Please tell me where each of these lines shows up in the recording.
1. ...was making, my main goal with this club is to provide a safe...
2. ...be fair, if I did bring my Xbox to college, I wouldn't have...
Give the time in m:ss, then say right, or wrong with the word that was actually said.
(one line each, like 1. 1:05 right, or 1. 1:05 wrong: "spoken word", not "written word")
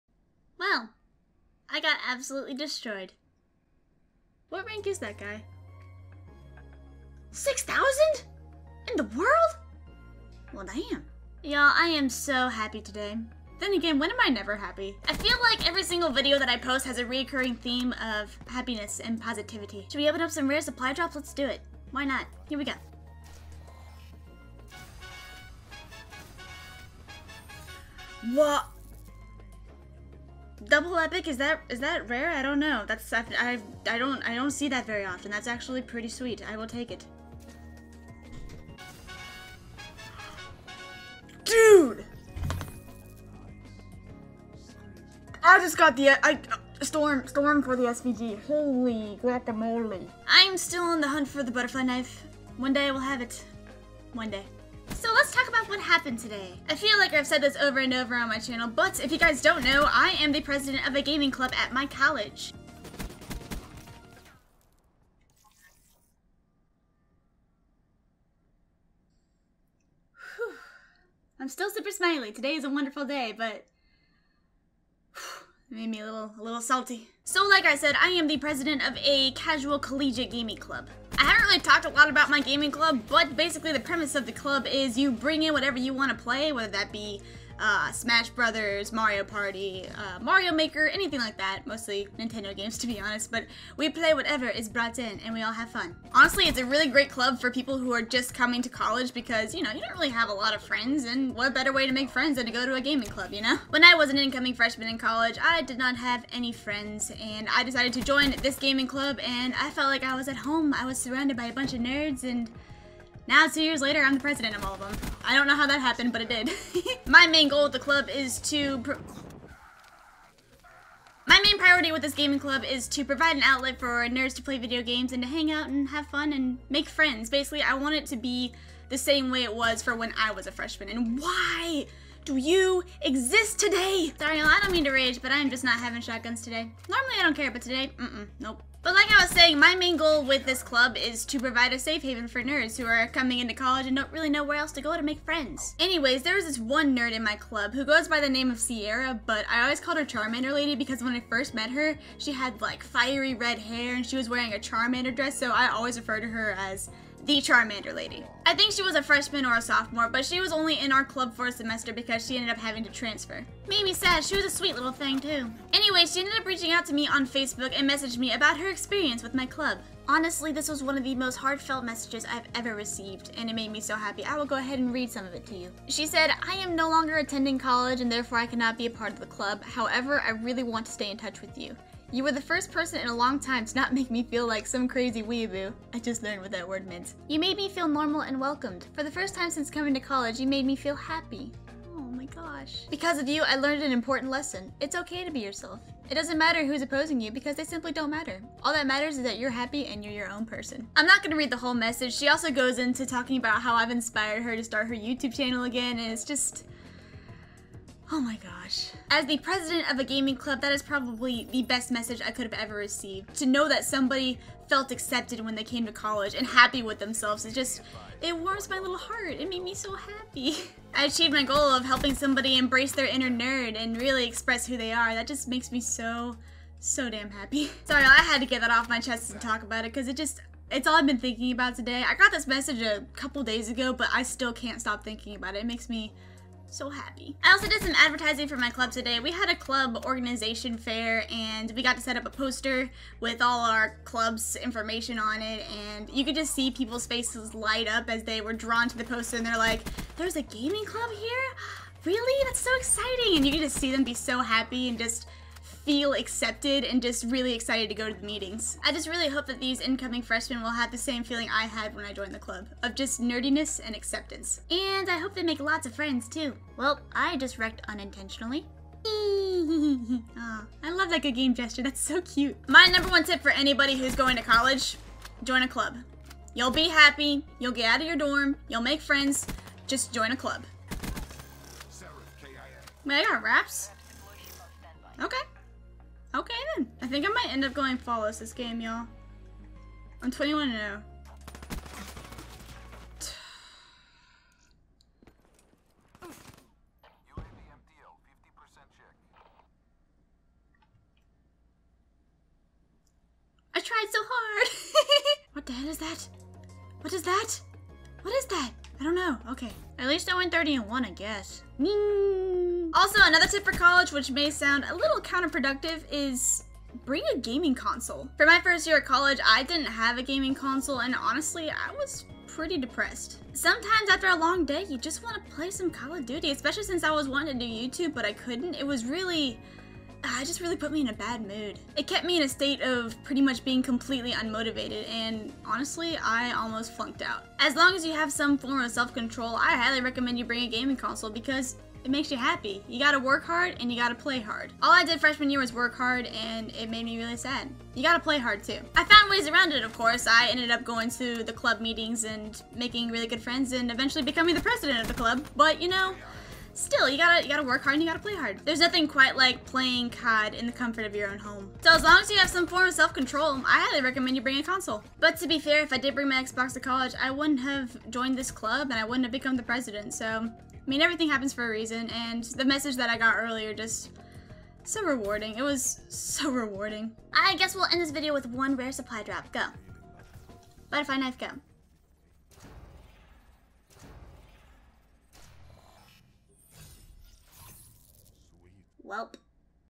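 1. 2:19 wrong: "saying", not "making"
2. 6:05 right.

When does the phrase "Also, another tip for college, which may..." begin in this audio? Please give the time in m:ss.
5:12.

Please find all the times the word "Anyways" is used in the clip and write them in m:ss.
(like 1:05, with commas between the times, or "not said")
2:25, 2:45.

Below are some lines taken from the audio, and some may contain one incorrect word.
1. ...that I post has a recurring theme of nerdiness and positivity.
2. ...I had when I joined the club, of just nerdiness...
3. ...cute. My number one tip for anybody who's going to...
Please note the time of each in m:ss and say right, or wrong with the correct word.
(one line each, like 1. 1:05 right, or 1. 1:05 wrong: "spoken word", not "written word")
1. 0:16 wrong: "happiness", not "nerdiness"
2. 4:21 right
3. 4:32 right.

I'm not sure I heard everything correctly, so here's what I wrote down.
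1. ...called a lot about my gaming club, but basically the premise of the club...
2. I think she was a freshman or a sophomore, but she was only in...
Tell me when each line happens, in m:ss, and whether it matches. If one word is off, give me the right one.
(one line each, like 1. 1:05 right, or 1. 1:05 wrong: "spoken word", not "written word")
1. 1:21 wrong: "talked", not "called"
2. 2:38 right.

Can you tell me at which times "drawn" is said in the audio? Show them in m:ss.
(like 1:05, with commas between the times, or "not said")
4:08.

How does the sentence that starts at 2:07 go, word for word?
Basically, I want it to be the same way it was for when I was a freshman.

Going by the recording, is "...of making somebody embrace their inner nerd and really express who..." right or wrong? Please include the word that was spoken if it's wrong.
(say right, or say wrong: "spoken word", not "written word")
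wrong: "helping", not "making".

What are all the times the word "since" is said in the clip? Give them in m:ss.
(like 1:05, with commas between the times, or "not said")
3:09, 5:26.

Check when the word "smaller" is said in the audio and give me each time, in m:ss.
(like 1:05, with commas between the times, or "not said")
not said.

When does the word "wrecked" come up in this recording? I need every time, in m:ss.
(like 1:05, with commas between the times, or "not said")
4:27.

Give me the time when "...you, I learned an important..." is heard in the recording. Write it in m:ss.
3:13.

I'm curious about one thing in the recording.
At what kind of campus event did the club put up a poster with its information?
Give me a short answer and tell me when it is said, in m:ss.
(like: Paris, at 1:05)
club organization fair, at 3:59.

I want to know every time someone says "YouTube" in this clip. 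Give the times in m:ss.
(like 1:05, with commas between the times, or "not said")
3:24, 5:27.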